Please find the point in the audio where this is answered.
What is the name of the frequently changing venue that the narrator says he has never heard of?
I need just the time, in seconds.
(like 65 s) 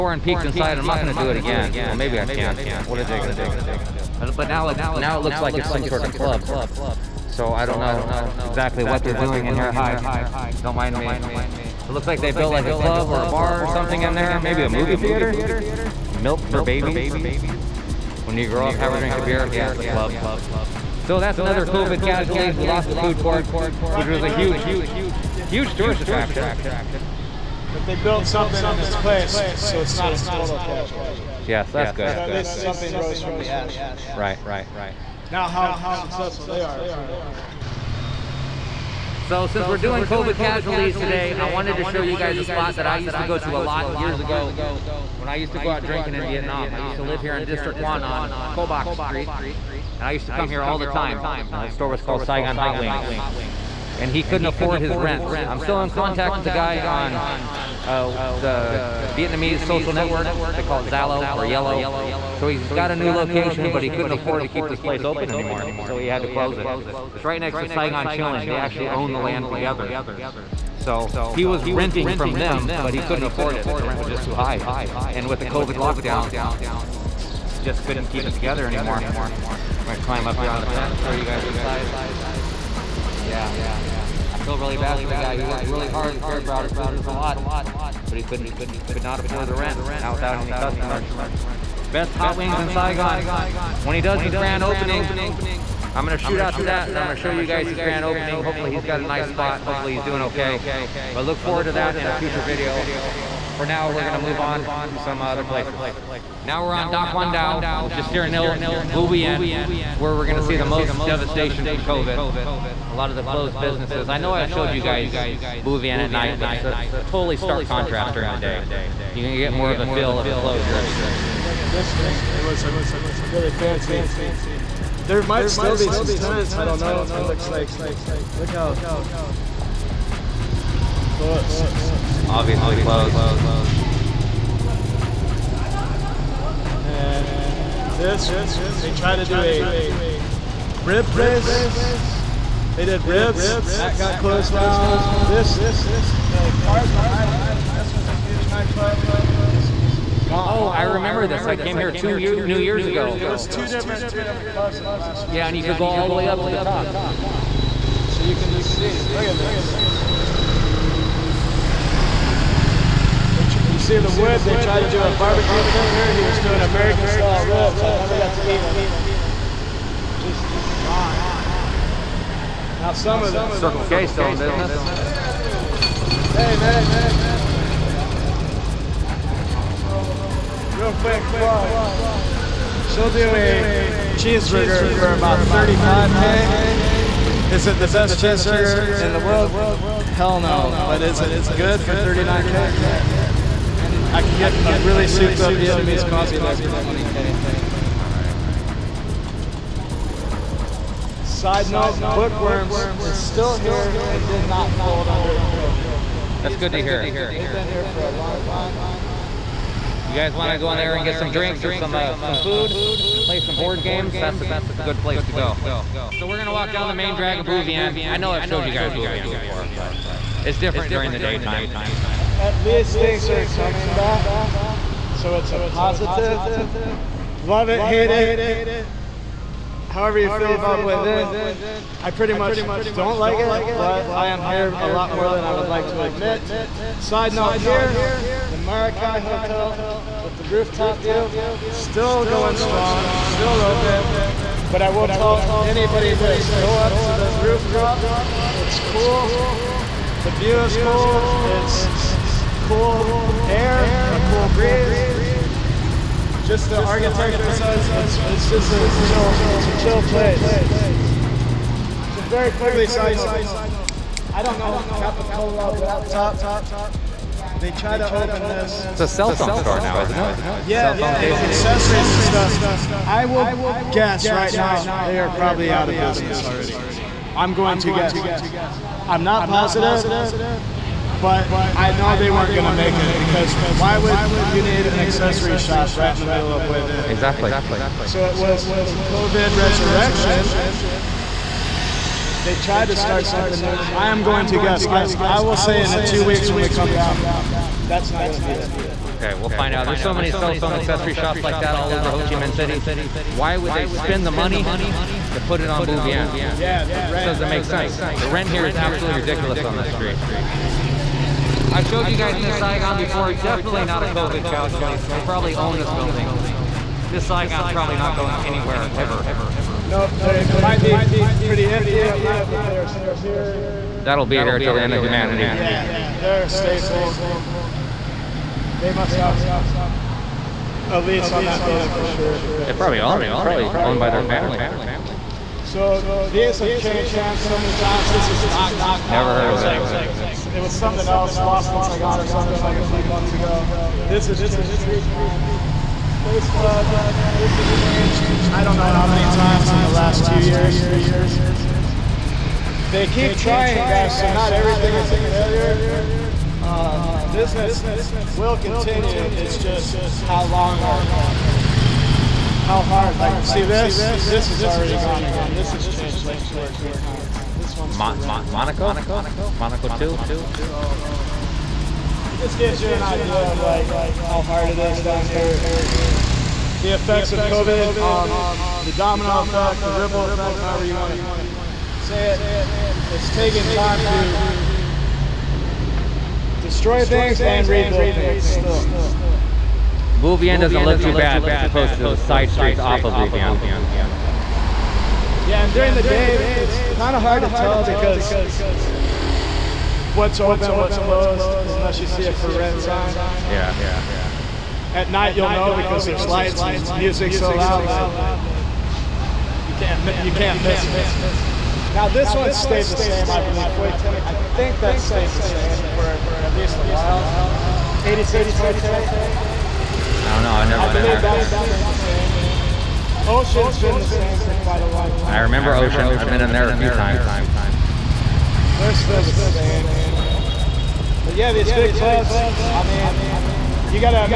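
338 s.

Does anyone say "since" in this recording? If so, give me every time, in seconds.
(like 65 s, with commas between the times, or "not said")
39 s, 341 s.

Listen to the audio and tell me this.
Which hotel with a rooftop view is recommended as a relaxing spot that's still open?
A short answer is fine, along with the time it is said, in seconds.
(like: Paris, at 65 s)
Maracay Hotel, at 238 s.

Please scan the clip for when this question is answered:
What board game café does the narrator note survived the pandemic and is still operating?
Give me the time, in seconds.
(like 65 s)
202 s.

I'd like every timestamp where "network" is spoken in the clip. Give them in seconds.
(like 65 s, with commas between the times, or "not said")
59 s.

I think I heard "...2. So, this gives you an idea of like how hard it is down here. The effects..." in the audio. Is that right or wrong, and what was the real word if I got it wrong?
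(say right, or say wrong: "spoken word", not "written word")
right.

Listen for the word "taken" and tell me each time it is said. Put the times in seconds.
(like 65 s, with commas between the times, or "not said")
383 s.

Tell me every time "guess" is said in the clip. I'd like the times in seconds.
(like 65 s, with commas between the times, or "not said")
273 s, 277 s, 294 s.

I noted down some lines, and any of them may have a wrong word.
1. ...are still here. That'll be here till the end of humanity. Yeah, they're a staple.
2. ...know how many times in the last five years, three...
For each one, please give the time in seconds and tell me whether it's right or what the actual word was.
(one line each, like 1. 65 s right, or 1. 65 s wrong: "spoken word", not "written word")
1. 322 s right
2. 348 s wrong: "two", not "five".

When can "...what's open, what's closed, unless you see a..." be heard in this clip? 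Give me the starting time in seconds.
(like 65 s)
400 s.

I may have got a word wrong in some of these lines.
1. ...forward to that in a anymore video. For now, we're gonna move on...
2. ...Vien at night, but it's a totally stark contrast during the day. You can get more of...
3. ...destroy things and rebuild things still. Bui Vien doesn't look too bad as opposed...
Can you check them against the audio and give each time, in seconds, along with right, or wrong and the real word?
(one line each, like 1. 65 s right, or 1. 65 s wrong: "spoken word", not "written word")
1. 101 s wrong: "future", not "anymore"
2. 115 s right
3. 386 s right.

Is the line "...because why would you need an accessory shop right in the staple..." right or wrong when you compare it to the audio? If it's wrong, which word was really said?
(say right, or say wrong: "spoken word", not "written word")
wrong: "middle", not "staple".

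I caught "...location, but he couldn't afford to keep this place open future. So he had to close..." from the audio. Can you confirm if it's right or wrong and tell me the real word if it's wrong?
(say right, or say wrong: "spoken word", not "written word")
wrong: "anymore", not "future".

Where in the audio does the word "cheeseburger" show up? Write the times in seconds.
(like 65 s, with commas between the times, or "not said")
184 s, 188 s.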